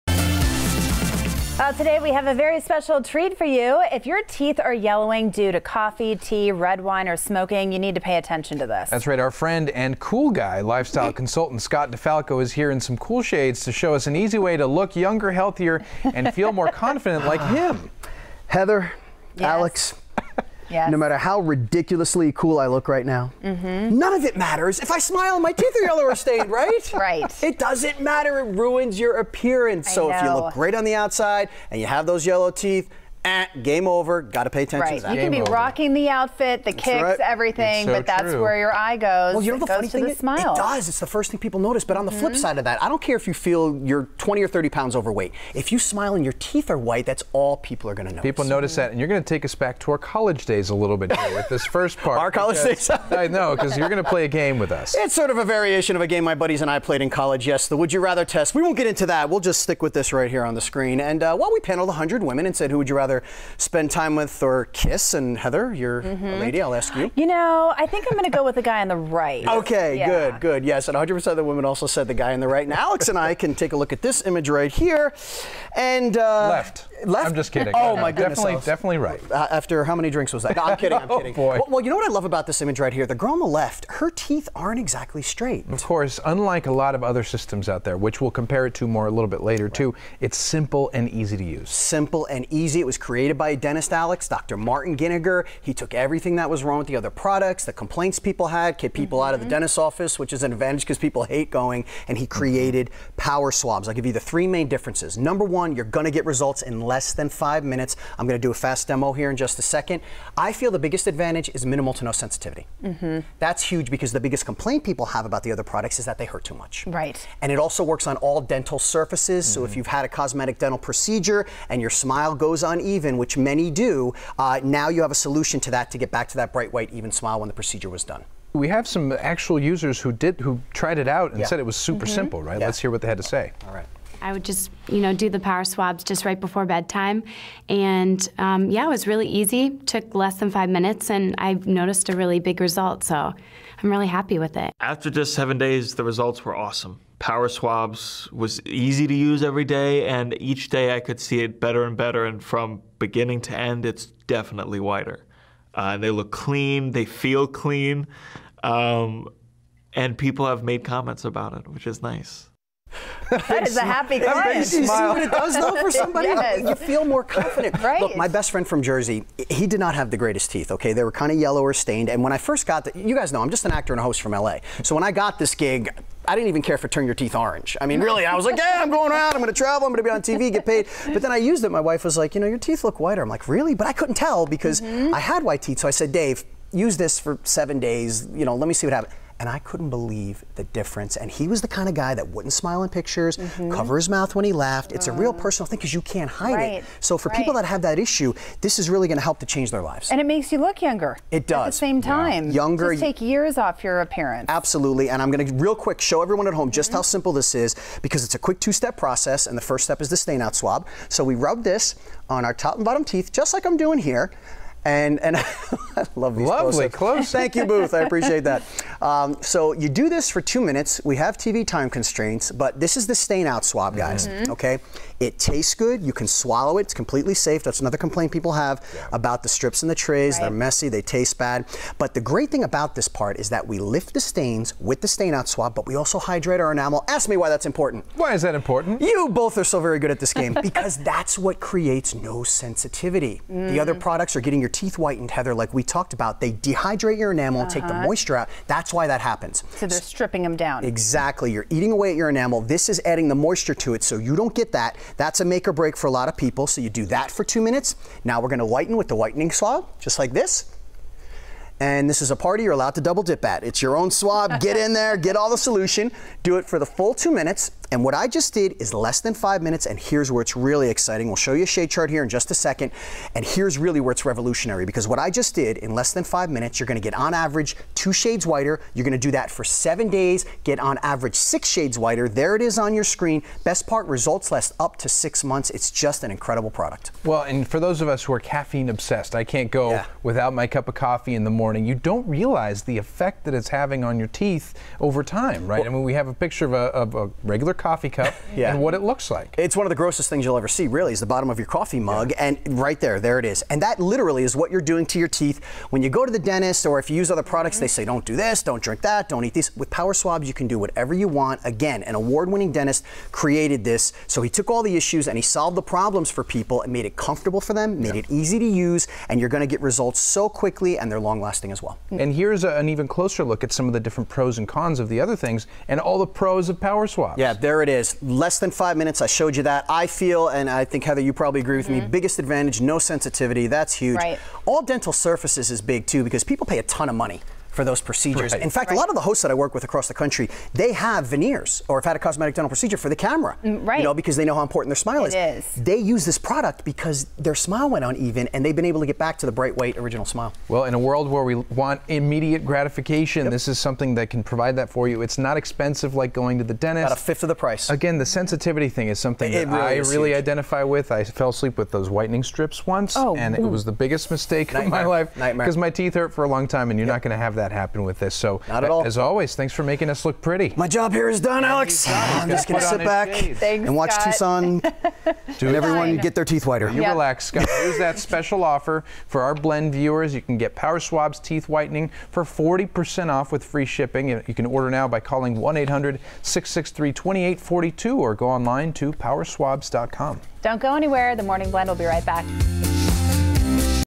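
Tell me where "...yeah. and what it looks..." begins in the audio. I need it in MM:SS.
04:58.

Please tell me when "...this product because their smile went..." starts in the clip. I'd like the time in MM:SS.
05:46.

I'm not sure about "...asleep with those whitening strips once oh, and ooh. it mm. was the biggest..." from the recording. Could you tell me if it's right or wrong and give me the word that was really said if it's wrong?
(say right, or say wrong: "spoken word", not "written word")
right.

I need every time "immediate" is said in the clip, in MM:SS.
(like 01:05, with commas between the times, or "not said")
05:52.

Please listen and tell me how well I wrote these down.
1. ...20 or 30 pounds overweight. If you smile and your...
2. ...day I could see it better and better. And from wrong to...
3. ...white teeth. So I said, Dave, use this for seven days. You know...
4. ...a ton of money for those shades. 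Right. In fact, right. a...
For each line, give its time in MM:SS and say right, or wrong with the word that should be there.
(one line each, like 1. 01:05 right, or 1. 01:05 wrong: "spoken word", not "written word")
1. 00:44 right
2. 02:30 wrong: "beginning", not "wrong"
3. 03:05 right
4. 05:36 wrong: "procedures", not "shades".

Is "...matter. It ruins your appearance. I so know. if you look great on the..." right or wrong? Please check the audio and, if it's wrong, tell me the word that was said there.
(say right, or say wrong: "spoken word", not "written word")
right.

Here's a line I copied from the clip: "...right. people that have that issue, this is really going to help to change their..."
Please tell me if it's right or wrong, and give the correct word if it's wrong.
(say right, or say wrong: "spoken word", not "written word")
right.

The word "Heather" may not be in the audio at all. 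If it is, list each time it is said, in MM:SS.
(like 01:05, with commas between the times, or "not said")
00:18, 01:05, 04:05, 05:31.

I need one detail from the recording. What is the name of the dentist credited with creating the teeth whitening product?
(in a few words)
Dr. Martin Giniger.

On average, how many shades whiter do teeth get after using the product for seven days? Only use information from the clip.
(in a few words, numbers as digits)
6.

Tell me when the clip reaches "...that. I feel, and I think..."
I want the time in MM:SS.
05:29.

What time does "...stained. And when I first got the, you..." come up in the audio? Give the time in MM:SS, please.
02:51.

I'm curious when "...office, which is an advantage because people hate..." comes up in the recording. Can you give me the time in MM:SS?
01:39.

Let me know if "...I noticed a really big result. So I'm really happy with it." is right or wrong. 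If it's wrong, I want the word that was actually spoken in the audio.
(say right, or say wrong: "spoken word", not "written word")
right.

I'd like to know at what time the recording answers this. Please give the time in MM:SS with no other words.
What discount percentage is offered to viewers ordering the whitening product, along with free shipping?
06:22.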